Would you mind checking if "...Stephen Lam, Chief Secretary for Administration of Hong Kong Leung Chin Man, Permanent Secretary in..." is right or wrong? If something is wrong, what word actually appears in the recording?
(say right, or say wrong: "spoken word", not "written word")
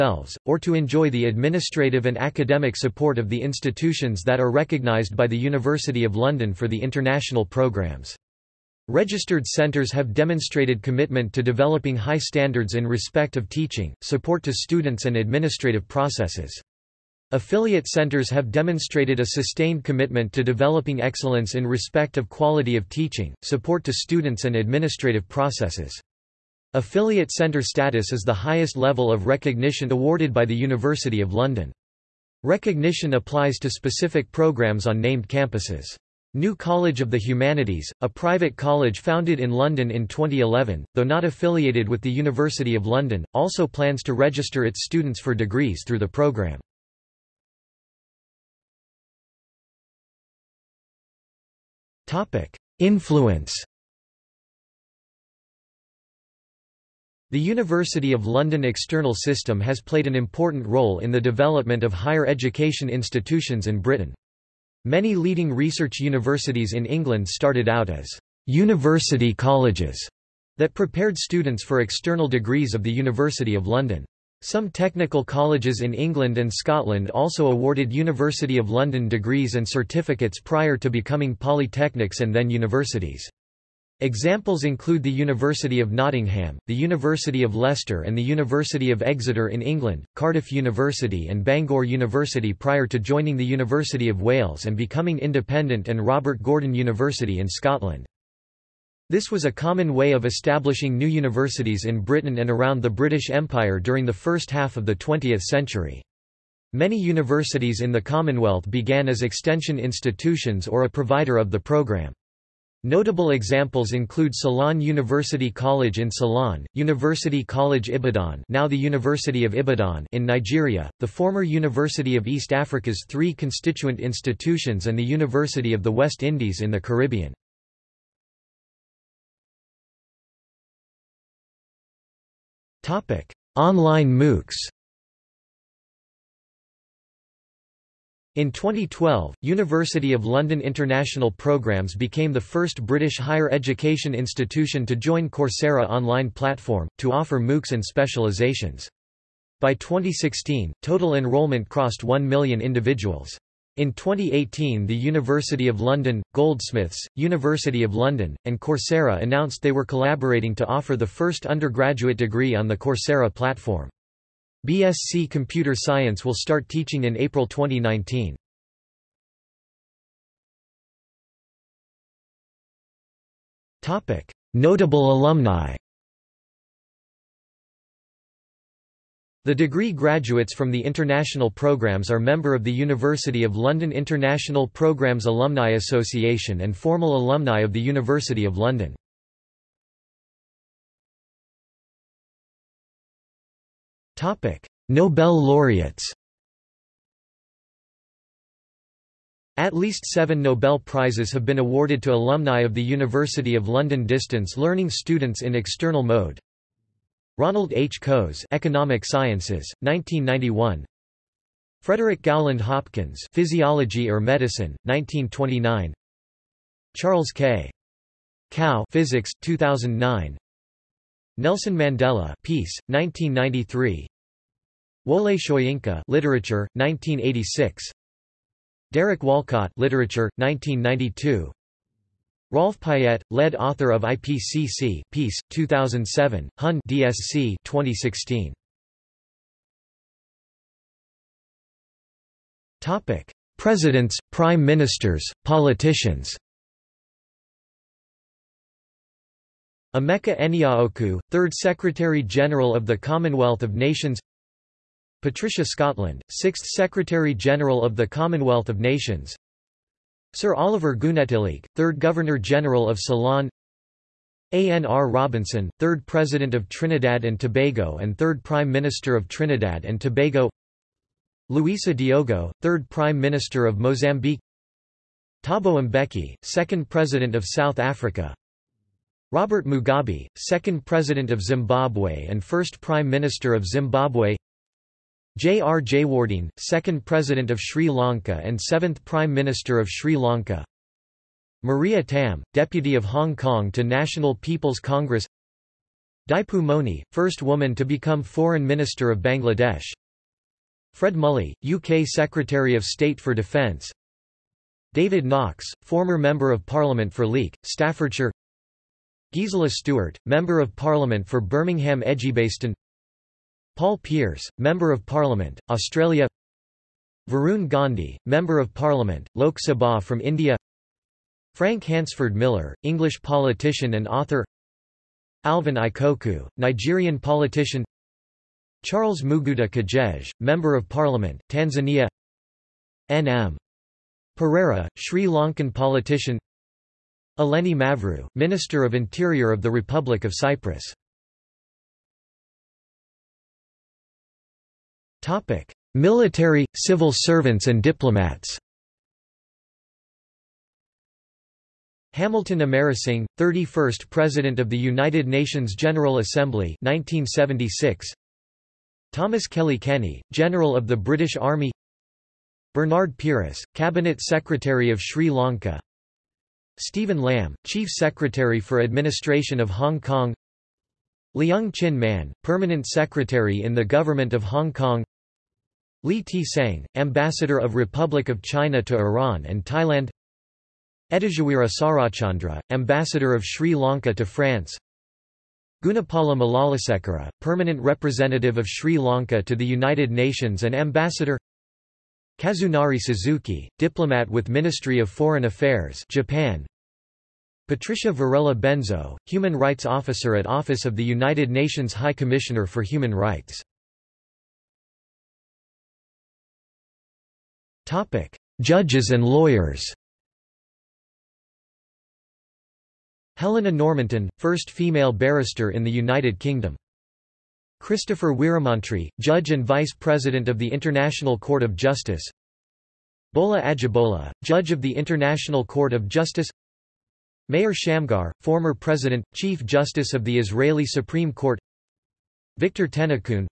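right.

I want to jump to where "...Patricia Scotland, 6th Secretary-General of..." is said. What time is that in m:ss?
4:15.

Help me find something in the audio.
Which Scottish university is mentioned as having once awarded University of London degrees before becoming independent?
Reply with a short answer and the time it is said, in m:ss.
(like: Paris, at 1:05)
Robert Gordon University, at 1:36.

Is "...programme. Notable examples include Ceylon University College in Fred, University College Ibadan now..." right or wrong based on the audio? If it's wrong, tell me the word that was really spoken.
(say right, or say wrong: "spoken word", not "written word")
wrong: "Ceylon", not "Fred".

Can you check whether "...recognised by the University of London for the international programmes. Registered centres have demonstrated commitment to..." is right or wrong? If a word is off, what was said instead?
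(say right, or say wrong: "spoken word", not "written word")
right.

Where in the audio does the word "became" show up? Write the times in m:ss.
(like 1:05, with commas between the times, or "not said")
2:21.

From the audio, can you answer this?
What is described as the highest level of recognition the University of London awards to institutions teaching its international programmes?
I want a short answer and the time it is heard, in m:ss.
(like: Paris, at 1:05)
Affiliate centre status, at 0:26.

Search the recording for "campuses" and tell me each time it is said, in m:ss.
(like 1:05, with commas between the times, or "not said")
0:35.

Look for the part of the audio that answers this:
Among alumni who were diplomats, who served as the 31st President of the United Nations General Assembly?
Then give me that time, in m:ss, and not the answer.
5:52.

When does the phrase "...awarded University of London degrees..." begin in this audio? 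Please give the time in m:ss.
1:17.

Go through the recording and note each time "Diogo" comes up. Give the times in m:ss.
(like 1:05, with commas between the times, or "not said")
4:31.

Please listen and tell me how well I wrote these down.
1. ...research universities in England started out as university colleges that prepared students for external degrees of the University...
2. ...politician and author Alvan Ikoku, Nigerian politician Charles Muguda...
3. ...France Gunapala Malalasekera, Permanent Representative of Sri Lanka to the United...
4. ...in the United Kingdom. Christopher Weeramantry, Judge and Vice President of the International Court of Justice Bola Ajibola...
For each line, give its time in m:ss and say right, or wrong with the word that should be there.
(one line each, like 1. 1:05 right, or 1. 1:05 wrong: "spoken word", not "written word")
1. 1:05 right
2. 5:23 right
3. 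6:24 right
4. 6:55 right.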